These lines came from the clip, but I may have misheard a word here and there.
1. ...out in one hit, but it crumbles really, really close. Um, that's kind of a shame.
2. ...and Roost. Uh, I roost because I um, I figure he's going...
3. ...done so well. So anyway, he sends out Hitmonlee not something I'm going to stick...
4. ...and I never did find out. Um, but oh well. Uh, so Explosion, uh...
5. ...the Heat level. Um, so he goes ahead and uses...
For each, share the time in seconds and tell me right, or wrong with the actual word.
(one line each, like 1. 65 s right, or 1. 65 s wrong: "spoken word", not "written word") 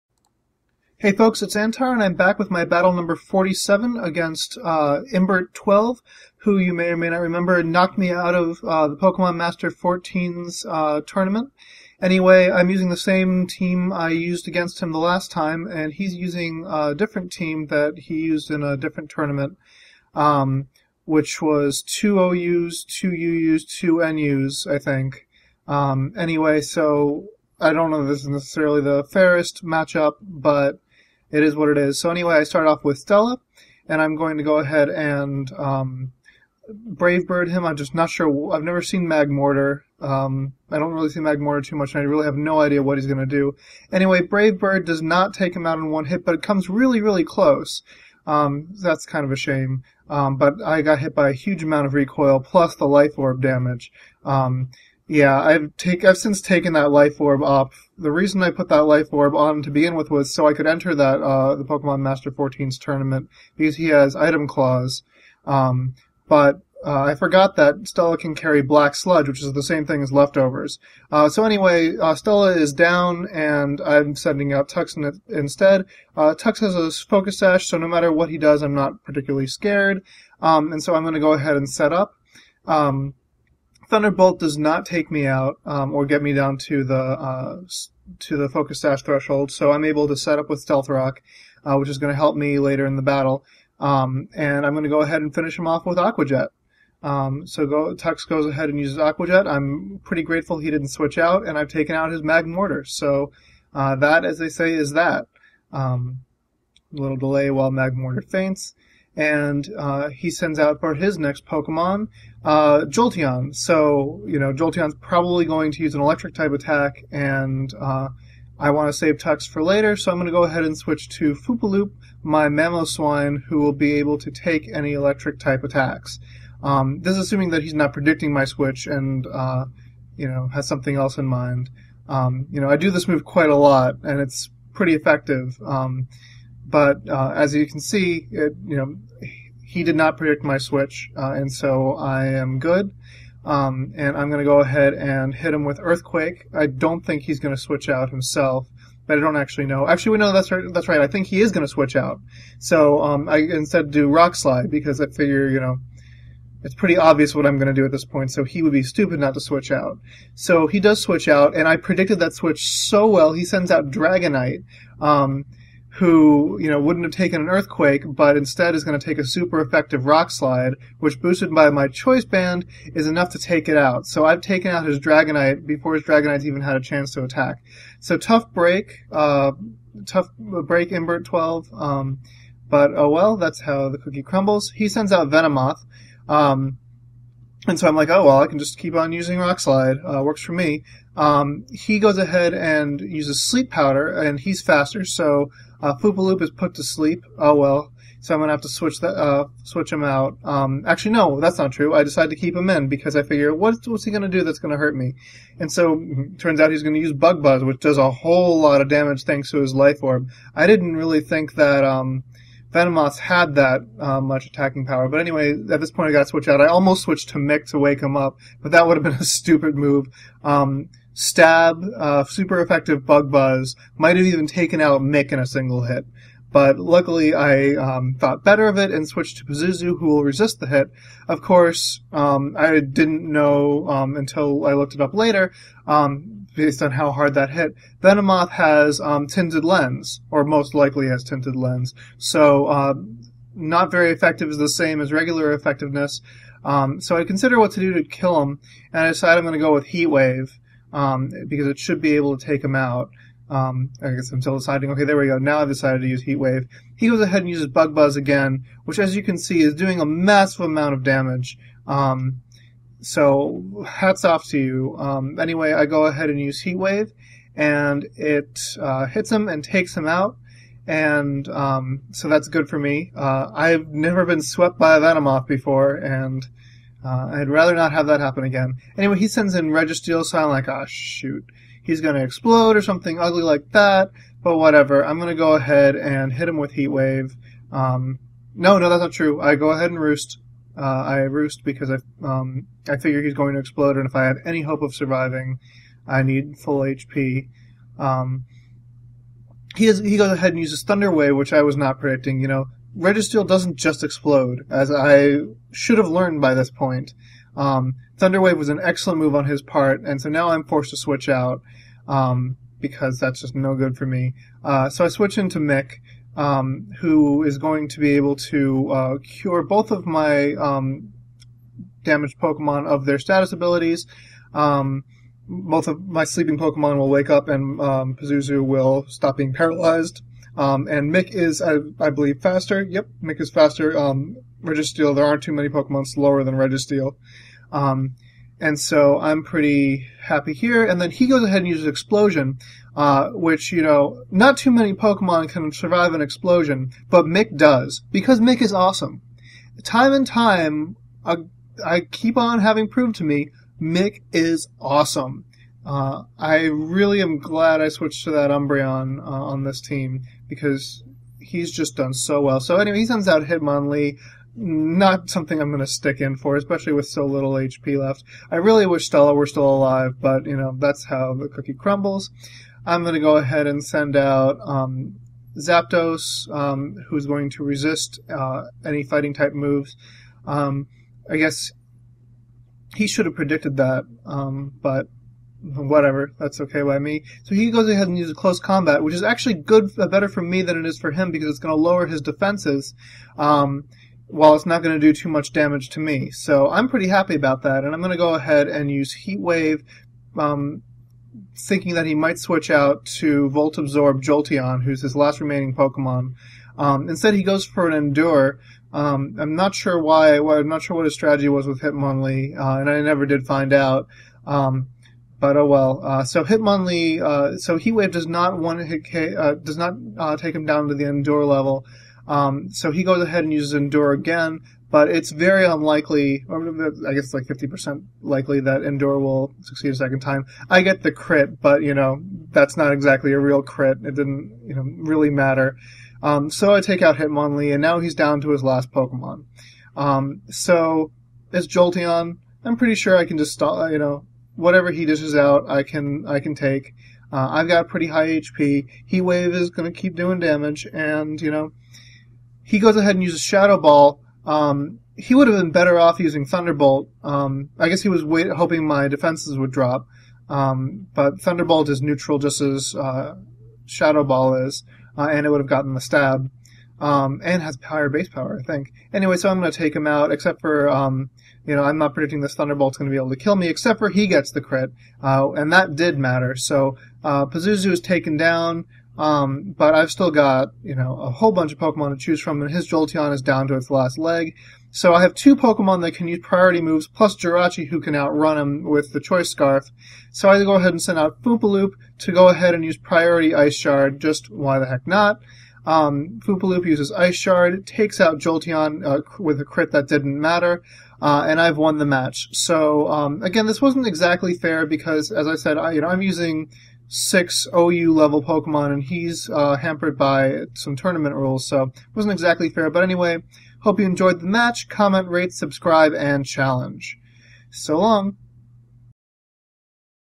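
1. 45 s wrong: "comes", not "crumbles"
2. 289 s right
3. 361 s right
4. 412 s wrong: "Hitmonlee", not "Explosion"
5. 420 s wrong: "Endure", not "Heat".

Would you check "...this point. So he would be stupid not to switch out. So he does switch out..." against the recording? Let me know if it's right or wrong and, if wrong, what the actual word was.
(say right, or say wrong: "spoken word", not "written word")
right.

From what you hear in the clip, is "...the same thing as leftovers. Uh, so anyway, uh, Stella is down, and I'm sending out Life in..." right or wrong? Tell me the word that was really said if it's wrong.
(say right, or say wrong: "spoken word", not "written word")
wrong: "Tux", not "Life".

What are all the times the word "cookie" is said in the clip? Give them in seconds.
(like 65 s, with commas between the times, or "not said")
183 s, 371 s.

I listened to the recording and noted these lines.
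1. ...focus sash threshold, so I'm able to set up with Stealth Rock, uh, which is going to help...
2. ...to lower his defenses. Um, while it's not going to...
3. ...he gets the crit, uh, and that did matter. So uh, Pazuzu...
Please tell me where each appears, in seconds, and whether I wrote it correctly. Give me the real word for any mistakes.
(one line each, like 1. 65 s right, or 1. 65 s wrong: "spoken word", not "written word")
1. 88 s right
2. 391 s right
3. 474 s right.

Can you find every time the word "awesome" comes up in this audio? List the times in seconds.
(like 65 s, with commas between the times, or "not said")
348 s, 354 s.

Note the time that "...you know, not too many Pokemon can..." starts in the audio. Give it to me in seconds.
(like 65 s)
343 s.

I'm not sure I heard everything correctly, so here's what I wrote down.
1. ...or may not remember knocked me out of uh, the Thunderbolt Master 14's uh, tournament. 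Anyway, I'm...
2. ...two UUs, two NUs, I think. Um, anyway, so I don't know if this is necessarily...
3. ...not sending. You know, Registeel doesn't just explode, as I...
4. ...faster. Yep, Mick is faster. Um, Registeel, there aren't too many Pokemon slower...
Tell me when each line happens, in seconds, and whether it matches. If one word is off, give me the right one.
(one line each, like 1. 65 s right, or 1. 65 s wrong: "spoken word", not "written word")
1. 6 s wrong: "Pokemon", not "Thunderbolt"
2. 22 s right
3. 301 s wrong: "predicting", not "sending"
4. 332 s right.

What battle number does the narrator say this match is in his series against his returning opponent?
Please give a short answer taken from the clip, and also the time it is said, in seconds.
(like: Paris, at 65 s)
47, at 3 s.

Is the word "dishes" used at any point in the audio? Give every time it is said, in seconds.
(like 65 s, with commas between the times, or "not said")
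445 s.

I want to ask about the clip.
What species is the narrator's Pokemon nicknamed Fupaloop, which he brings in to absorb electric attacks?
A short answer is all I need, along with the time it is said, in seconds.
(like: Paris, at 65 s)
Mamoswine, at 122 s.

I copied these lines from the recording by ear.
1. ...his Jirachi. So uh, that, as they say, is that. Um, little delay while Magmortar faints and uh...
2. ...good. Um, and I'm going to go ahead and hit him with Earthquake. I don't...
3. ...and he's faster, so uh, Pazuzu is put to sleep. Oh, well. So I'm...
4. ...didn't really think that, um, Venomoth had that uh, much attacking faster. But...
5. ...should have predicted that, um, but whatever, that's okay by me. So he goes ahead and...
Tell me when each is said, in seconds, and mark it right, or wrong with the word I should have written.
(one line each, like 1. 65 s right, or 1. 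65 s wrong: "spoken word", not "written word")
1. 102 s wrong: "Magmortar", not "Jirachi"
2. 142 s right
3. 194 s wrong: "Poopaloop", not "Pazuzu"
4. 210 s wrong: "power", not "faster"
5. 383 s right.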